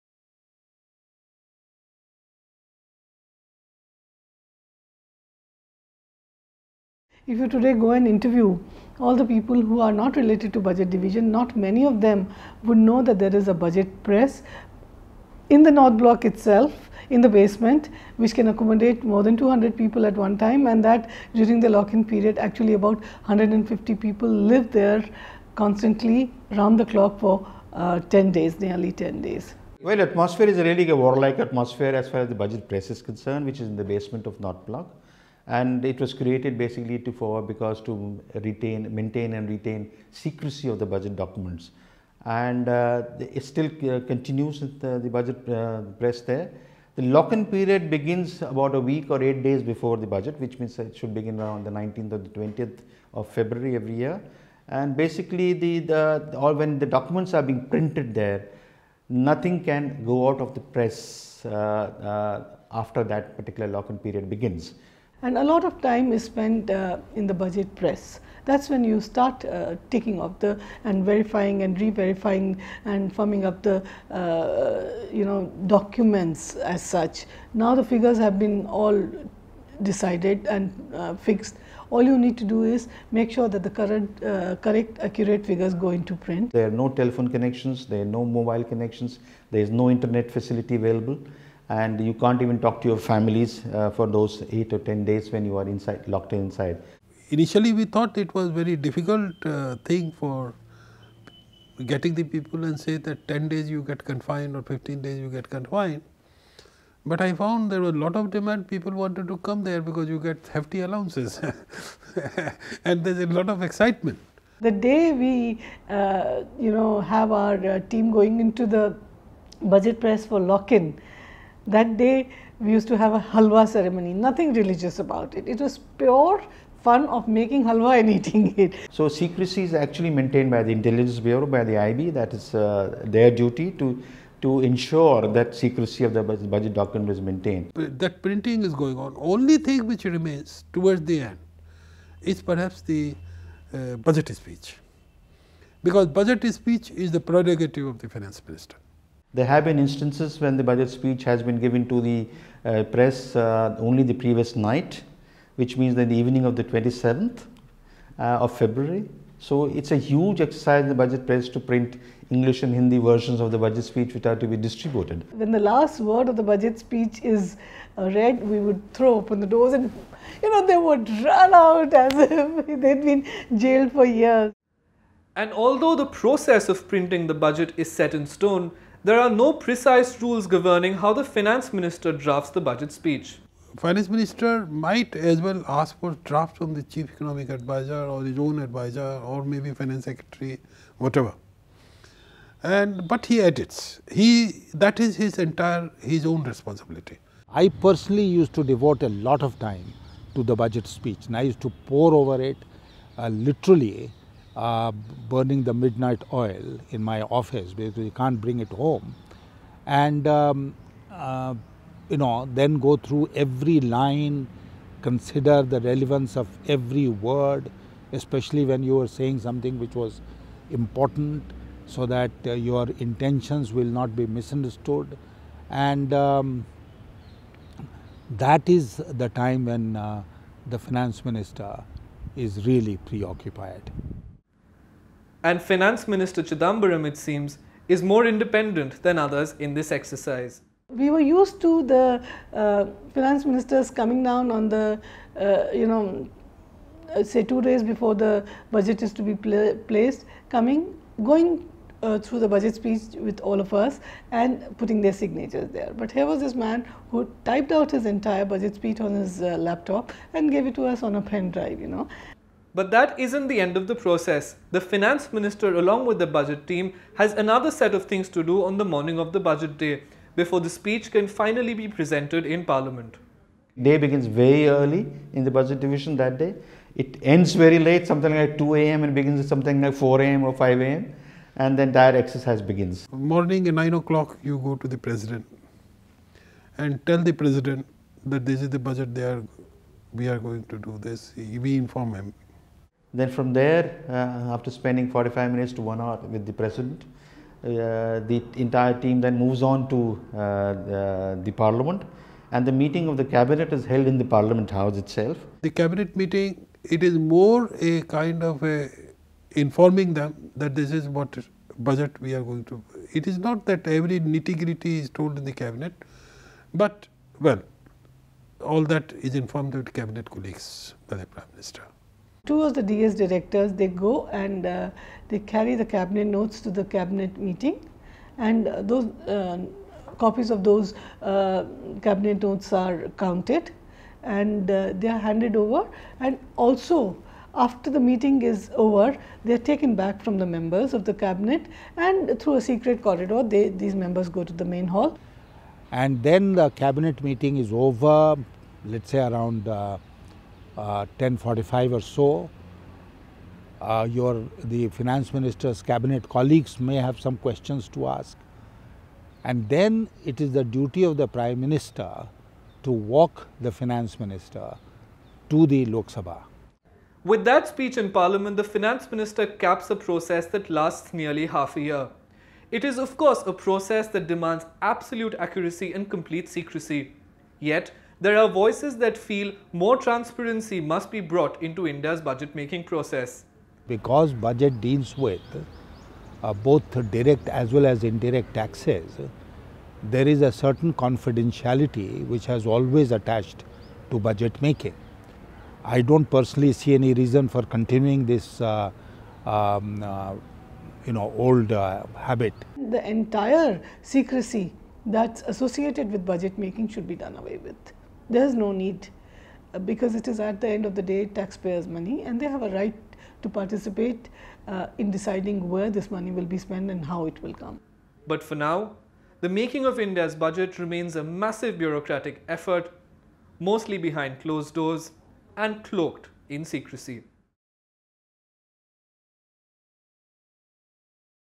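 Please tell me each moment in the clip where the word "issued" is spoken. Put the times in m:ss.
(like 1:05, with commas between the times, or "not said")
not said.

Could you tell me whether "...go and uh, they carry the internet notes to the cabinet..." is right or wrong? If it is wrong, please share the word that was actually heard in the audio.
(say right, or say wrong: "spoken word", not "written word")
wrong: "cabinet", not "internet".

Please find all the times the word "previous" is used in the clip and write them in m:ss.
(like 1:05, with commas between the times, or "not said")
2:34.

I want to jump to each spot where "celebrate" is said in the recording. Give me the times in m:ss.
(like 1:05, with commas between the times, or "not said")
not said.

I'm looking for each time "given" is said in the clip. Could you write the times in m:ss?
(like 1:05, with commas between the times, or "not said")
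2:31.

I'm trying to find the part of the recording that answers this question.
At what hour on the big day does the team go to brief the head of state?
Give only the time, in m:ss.
4:43.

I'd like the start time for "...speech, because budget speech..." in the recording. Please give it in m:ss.
2:24.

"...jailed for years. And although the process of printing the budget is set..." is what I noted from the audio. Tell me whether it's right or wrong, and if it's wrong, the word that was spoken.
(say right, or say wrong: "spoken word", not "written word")
right.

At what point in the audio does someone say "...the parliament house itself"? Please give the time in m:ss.
5:04.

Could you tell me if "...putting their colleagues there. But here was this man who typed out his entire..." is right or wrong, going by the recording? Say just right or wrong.
wrong.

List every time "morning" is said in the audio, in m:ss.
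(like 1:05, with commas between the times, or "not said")
4:28, 4:43.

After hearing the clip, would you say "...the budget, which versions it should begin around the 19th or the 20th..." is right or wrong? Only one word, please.
wrong.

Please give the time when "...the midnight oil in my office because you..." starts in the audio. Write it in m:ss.
3:25.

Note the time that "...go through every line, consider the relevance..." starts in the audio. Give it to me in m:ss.
3:32.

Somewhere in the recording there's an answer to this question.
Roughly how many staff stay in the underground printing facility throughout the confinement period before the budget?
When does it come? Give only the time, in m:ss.
0:23.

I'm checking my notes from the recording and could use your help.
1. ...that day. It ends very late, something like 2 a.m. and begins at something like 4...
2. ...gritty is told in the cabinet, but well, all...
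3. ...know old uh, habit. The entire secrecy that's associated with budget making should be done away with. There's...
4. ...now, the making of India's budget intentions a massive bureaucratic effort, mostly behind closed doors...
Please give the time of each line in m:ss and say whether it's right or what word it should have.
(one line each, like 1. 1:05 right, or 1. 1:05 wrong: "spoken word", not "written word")
1. 4:36 right
2. 5:14 right
3. 6:41 right
4. 6:58 wrong: "remains", not "intentions".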